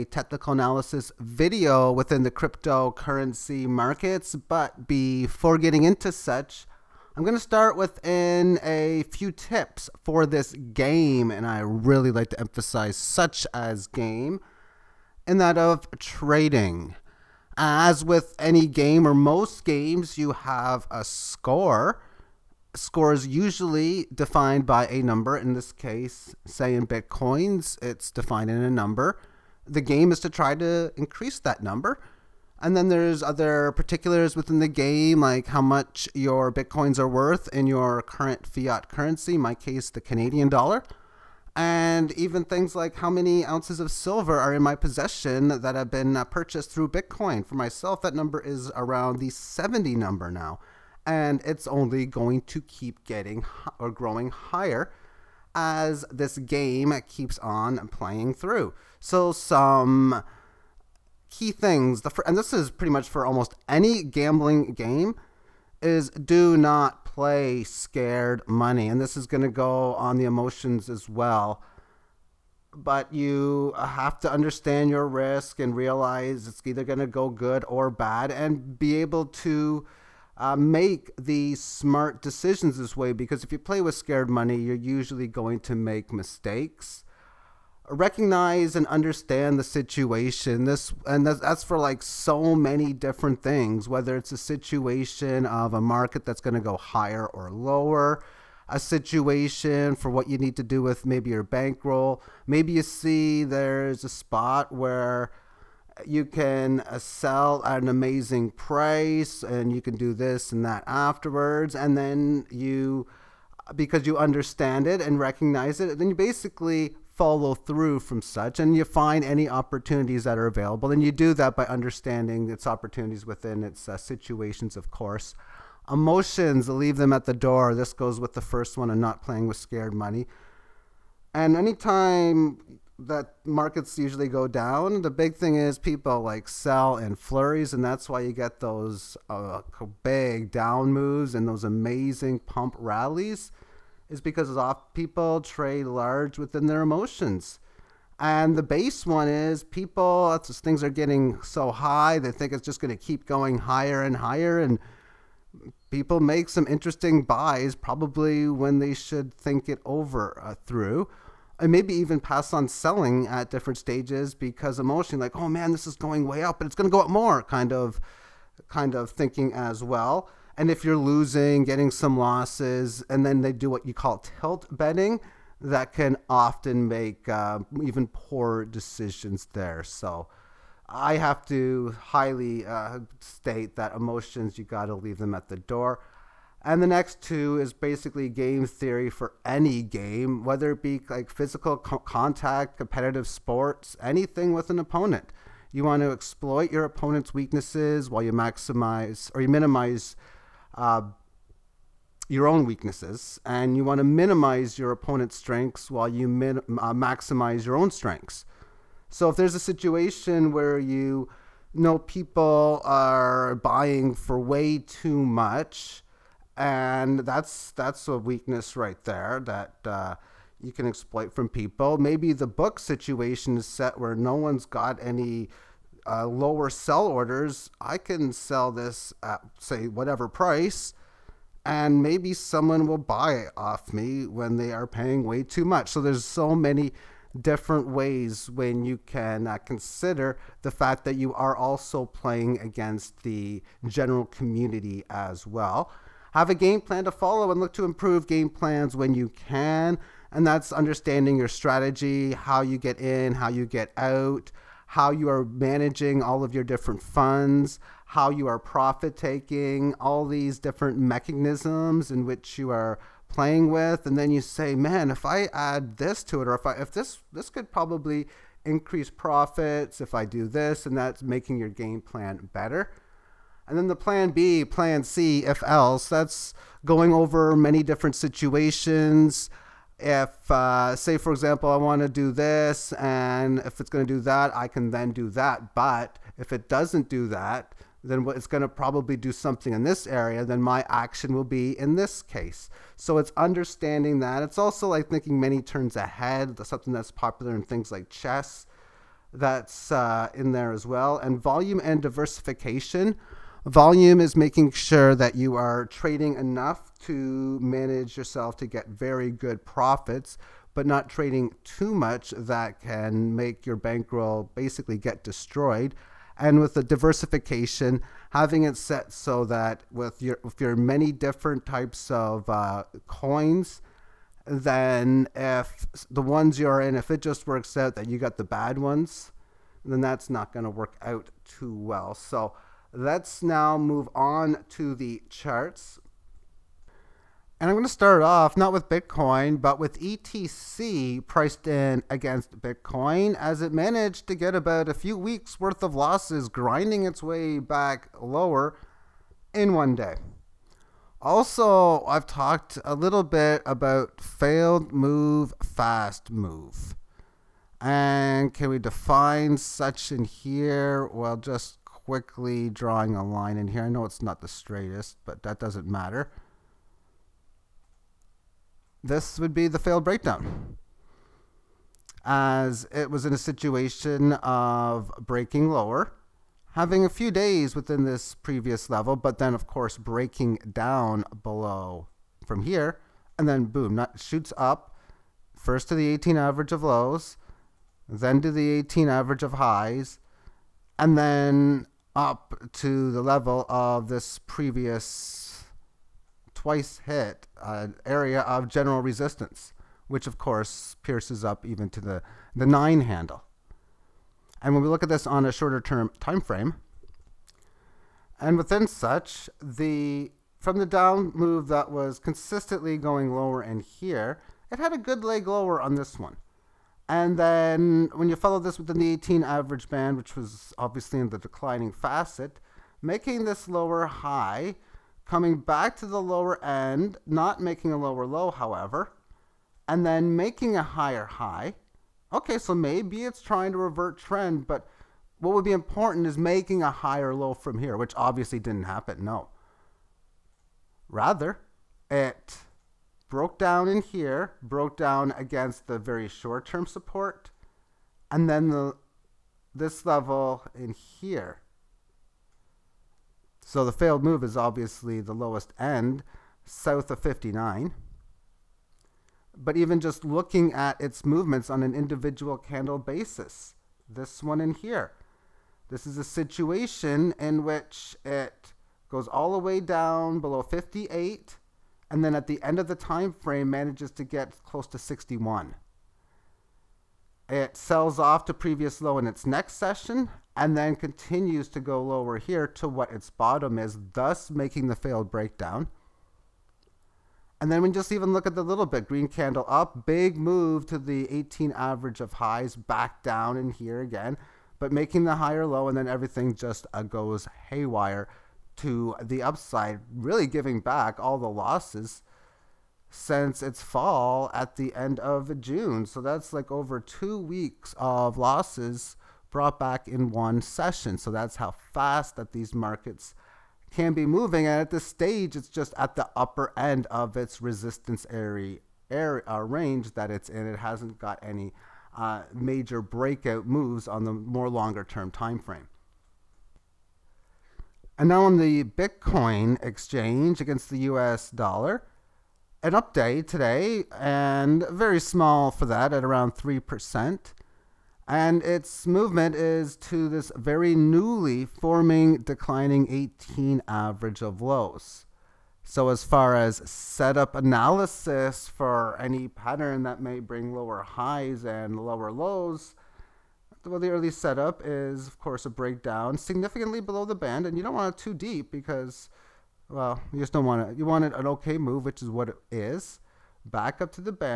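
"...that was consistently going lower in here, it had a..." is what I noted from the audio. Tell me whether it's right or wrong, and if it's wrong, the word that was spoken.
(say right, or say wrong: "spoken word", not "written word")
right.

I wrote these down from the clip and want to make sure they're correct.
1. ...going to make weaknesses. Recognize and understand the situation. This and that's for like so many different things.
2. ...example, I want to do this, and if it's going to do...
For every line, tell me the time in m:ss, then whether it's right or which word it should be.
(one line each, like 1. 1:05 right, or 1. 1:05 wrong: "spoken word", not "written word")
1. 1:25 wrong: "mistakes", not "weaknesses"
2. 4:41 right.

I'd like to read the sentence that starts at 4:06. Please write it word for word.
Have a game plan to follow and look to improve game plans when you can.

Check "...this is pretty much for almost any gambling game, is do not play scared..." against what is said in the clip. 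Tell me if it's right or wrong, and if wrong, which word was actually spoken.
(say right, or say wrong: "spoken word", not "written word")
right.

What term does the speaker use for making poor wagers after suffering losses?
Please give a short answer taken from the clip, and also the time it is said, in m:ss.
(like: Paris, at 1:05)
tilt betting, at 2:54.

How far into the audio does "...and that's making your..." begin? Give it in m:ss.
4:30.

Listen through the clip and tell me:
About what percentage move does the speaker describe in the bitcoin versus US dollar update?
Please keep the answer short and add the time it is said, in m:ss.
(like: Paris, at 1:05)
3%, at 8:56.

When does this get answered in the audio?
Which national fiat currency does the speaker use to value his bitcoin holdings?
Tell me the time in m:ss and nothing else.
0:39.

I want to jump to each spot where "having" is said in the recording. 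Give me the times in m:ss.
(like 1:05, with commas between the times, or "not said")
5:18, 6:16.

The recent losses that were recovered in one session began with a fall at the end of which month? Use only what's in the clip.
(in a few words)
June.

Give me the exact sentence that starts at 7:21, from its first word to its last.
Rather, it broke down in here, broke down against the very short-term support, and then the this level in here.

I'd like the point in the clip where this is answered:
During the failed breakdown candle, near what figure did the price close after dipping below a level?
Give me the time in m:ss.
7:54.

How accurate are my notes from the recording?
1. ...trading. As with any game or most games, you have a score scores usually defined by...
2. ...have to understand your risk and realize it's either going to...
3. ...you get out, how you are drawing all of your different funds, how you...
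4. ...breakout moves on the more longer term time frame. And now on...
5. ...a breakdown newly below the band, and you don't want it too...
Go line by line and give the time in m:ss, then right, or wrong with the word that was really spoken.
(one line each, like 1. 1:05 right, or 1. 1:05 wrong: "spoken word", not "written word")
1. 0:15 right
2. 1:13 right
3. 4:13 wrong: "managing", not "drawing"
4. 8:43 right
5. 9:15 wrong: "significantly", not "newly".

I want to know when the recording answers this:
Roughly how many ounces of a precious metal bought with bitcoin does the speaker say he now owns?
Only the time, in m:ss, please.
0:49.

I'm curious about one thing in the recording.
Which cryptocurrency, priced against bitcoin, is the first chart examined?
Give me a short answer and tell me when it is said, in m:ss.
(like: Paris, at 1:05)
ETC, at 5:40.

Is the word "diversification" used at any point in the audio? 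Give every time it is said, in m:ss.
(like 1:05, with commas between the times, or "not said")
5:02, 5:16.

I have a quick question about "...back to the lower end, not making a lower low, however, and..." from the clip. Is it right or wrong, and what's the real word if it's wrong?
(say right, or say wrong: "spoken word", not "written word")
right.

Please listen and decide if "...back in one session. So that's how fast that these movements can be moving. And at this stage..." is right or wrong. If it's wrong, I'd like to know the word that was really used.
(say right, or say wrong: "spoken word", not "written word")
wrong: "markets", not "movements".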